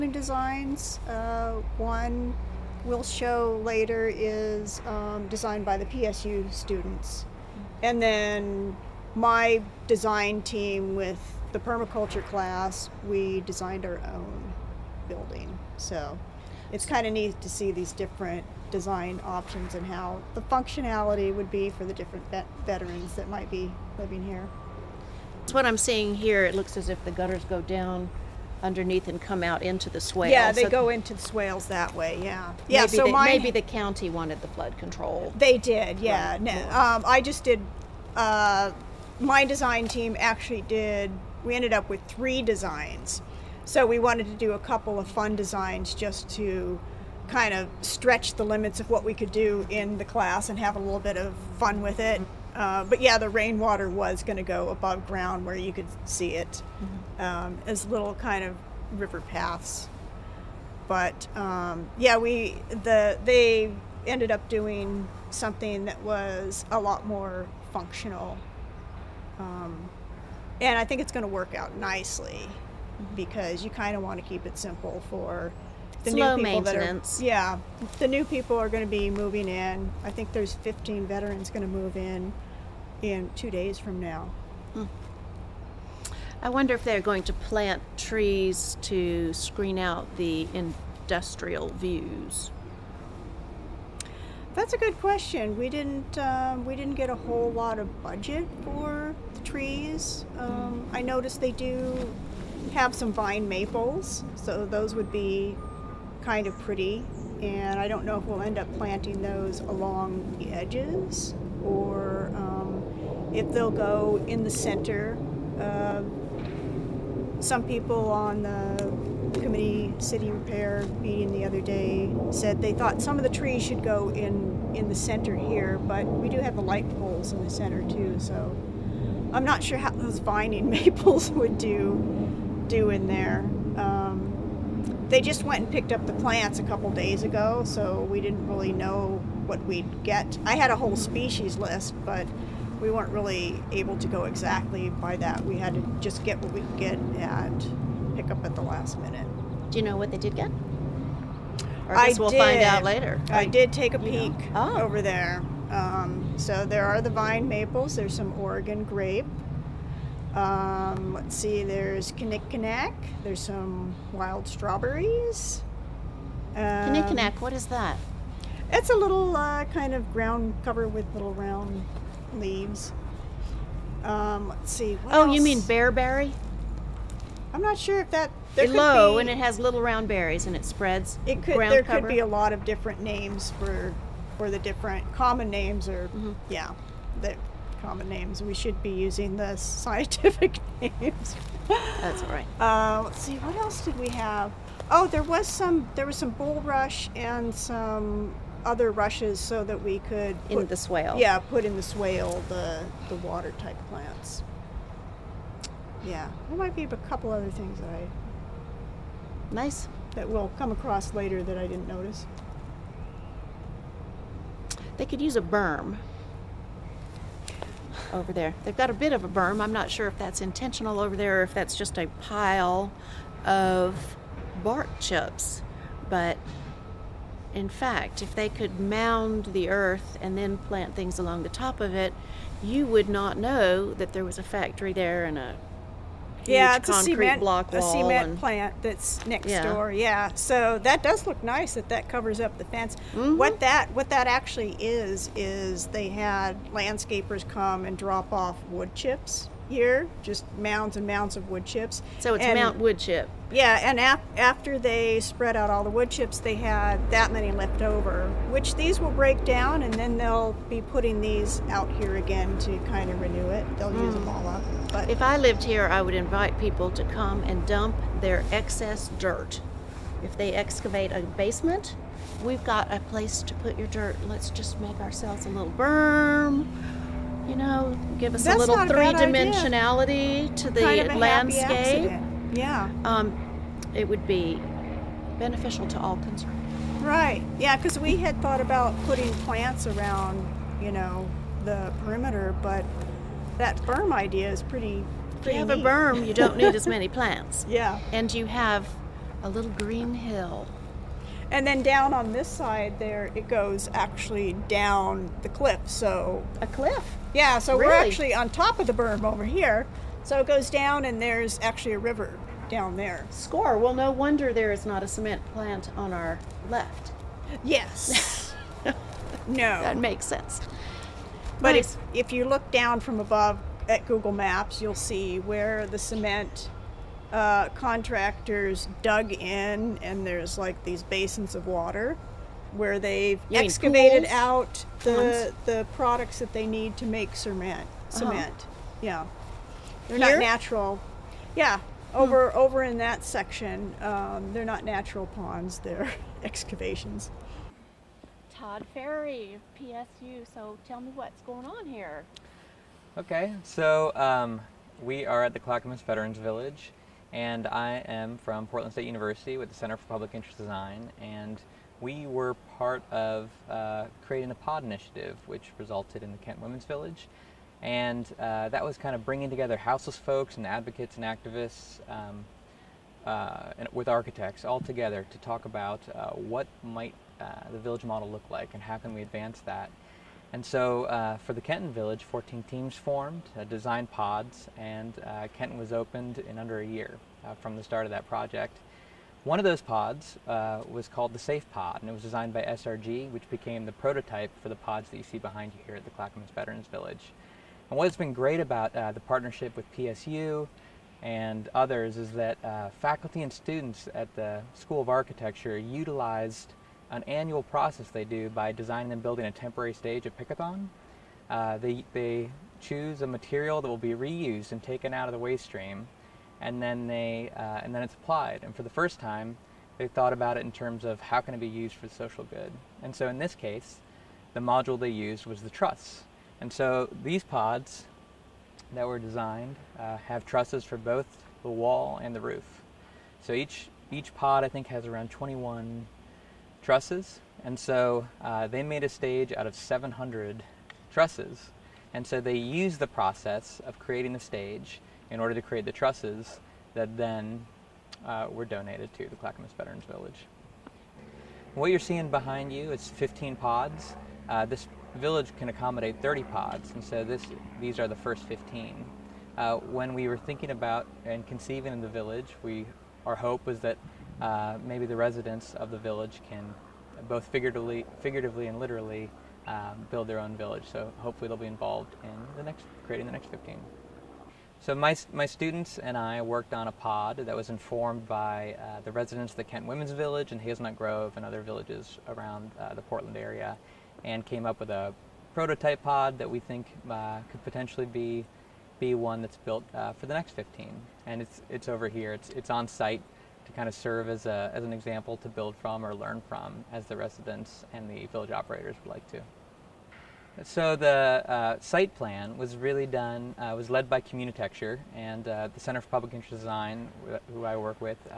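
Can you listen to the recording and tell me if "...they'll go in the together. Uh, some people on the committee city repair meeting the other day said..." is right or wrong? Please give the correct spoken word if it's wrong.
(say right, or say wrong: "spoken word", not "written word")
wrong: "center", not "together".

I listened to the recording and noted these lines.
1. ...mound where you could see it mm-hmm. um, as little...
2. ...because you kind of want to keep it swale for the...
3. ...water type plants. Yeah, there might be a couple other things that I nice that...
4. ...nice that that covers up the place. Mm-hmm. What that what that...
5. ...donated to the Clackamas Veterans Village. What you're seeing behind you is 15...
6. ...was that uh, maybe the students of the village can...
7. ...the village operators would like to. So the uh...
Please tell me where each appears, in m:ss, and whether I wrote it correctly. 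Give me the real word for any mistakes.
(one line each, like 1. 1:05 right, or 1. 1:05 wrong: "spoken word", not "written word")
1. 0:55 wrong: "ground", not "mound"
2. 1:13 wrong: "simple", not "swale"
3. 3:23 right
4. 4:01 wrong: "fence", not "place"
5. 7:28 right
6. 7:43 wrong: "residents", not "students"
7. 8:18 right.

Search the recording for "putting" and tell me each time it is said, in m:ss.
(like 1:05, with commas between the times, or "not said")
4:20, 4:49.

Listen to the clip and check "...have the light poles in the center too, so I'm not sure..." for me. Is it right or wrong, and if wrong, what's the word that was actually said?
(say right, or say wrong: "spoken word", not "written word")
right.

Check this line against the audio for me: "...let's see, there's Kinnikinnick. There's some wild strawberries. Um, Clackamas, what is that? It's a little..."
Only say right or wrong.
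wrong.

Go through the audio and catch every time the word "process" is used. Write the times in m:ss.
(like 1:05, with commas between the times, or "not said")
6:47, 7:23.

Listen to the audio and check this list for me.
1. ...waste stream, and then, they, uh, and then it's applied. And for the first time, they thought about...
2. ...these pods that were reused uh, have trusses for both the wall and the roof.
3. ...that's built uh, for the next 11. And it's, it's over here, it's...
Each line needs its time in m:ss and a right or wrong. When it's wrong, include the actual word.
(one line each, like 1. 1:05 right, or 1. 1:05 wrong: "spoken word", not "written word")
1. 6:55 right
2. 7:07 wrong: "designed", not "reused"
3. 8:09 wrong: "15", not "11".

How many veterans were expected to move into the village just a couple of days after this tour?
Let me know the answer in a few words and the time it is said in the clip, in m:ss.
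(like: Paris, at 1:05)
15, at 1:20.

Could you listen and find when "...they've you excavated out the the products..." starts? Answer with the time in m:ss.
5:32.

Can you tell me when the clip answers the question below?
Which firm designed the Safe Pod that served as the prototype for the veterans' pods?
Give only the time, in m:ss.
6:32.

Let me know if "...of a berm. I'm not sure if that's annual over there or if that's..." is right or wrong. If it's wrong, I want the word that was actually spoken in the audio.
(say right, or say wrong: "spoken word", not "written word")
wrong: "intentional", not "annual".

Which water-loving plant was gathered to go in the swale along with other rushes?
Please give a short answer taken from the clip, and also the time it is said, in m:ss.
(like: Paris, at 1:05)
Bulrush, at 3:16.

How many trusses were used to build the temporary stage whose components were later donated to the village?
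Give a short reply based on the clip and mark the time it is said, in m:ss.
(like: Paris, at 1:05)
700, at 7:19.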